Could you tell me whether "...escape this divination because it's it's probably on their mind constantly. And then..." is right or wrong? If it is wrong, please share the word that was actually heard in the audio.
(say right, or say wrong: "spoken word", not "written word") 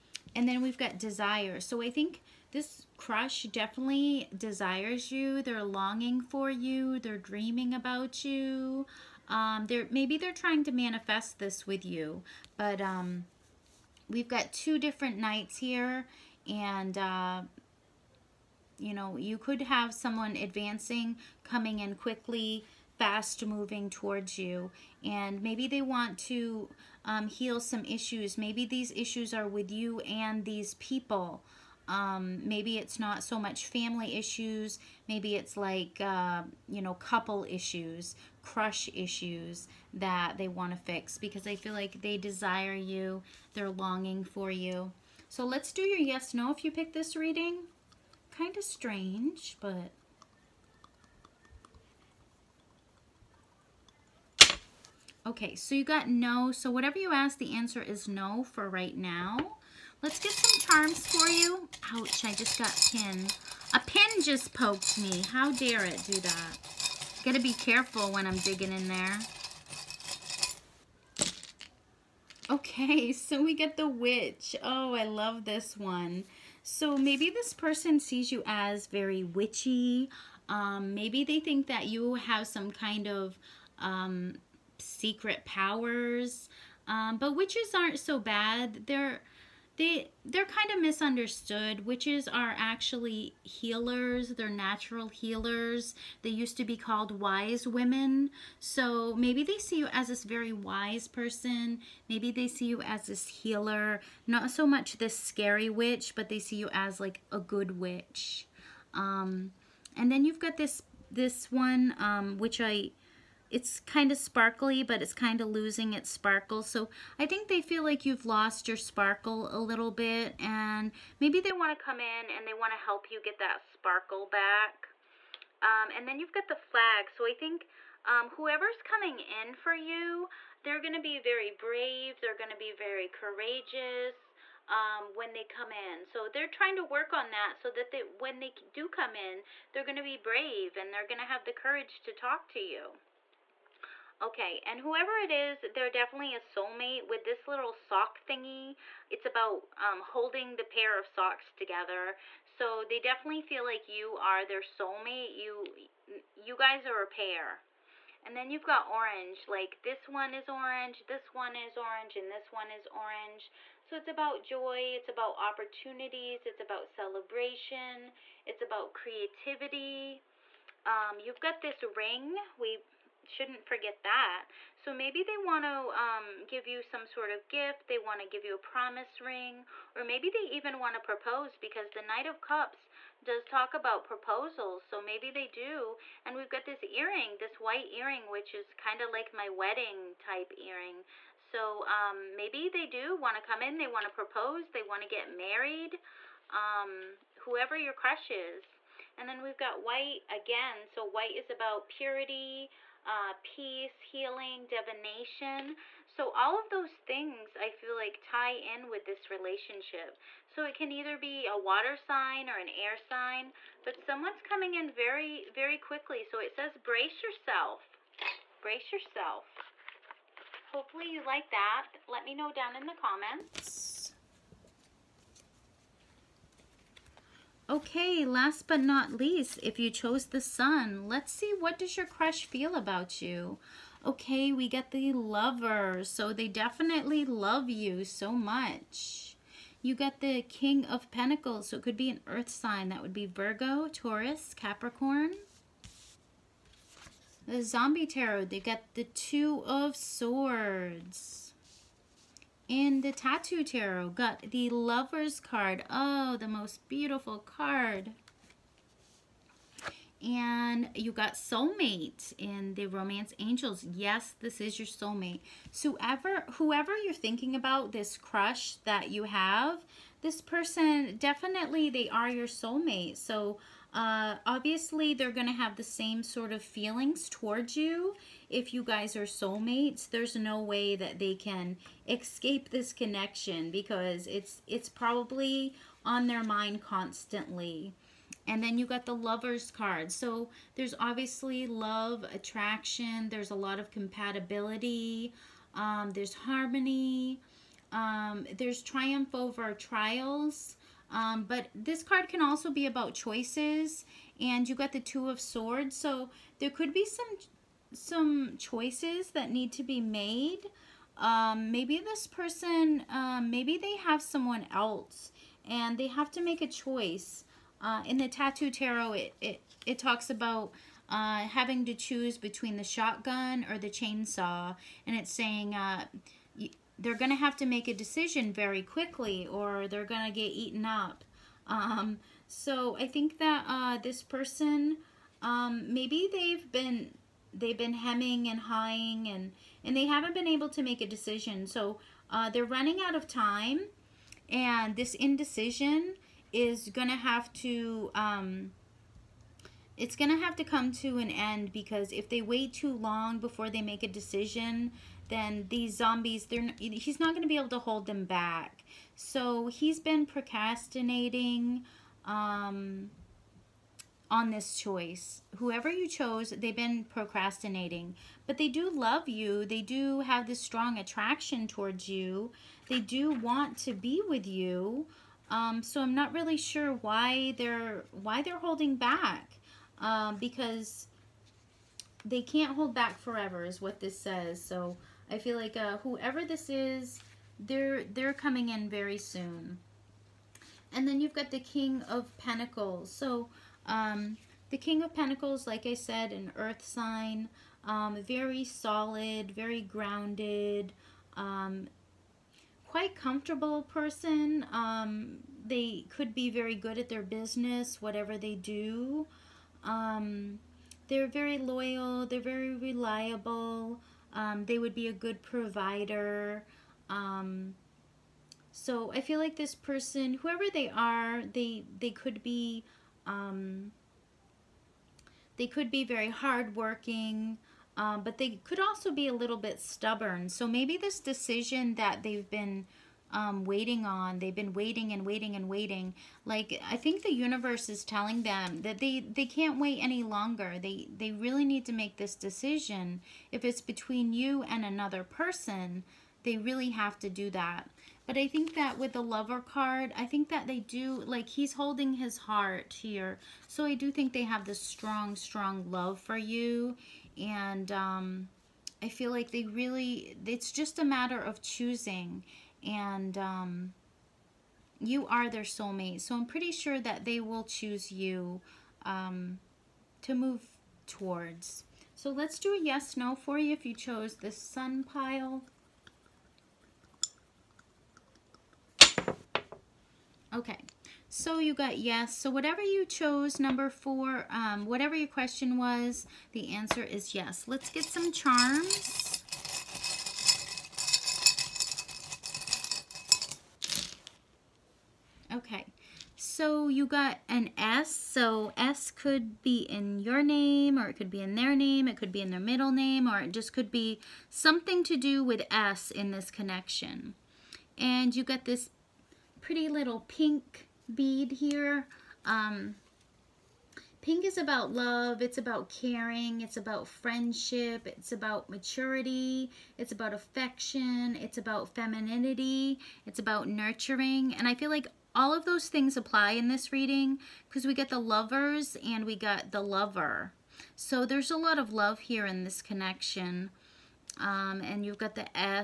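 wrong: "connection", not "divination".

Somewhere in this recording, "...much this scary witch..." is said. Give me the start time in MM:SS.
01:44.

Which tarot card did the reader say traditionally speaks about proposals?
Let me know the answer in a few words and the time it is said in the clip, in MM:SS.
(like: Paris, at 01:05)
Knight of Cups, at 03:02.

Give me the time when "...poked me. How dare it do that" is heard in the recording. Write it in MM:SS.
01:04.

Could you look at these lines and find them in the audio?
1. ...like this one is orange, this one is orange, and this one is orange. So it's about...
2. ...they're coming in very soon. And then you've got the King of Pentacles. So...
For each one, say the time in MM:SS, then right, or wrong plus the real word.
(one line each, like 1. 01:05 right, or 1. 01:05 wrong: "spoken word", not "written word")
1. 02:39 right
2. 06:28 right.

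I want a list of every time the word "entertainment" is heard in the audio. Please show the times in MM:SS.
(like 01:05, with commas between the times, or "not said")
not said.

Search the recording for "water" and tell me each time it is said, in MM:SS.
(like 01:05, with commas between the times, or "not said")
03:31.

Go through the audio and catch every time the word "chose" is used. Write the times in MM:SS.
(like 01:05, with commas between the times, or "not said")
03:49, 06:06, 07:53, 08:03.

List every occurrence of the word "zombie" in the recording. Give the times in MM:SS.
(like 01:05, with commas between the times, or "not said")
04:07, 05:55.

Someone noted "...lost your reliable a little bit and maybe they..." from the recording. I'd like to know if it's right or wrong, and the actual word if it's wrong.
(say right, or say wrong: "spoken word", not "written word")
wrong: "sparkle", not "reliable".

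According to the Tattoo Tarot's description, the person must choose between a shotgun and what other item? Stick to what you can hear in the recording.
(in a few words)
Chainsaw.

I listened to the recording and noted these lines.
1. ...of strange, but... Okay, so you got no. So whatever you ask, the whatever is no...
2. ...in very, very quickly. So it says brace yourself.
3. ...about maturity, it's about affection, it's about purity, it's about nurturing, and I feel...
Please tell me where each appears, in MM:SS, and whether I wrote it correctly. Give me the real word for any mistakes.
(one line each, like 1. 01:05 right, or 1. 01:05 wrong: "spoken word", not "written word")
1. 00:48 wrong: "answer", not "whatever"
2. 03:34 right
3. 08:38 wrong: "femininity", not "purity".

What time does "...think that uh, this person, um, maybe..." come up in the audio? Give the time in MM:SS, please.
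05:33.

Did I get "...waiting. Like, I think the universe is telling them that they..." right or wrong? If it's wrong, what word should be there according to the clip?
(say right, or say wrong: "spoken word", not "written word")
right.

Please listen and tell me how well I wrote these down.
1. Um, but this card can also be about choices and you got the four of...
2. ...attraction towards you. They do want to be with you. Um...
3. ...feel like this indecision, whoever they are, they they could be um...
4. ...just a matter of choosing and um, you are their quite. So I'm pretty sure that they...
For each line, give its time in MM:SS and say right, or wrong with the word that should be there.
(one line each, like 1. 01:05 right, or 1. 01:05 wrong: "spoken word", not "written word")
1. 05:01 wrong: "two", not "four"
2. 06:10 right
3. 06:59 wrong: "person", not "indecision"
4. 07:40 wrong: "soulmate", not "quite".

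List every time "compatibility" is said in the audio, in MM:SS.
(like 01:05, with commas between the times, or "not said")
04:53.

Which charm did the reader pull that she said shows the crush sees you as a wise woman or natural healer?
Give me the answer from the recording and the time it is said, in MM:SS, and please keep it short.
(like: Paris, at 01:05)
The witch, at 01:13.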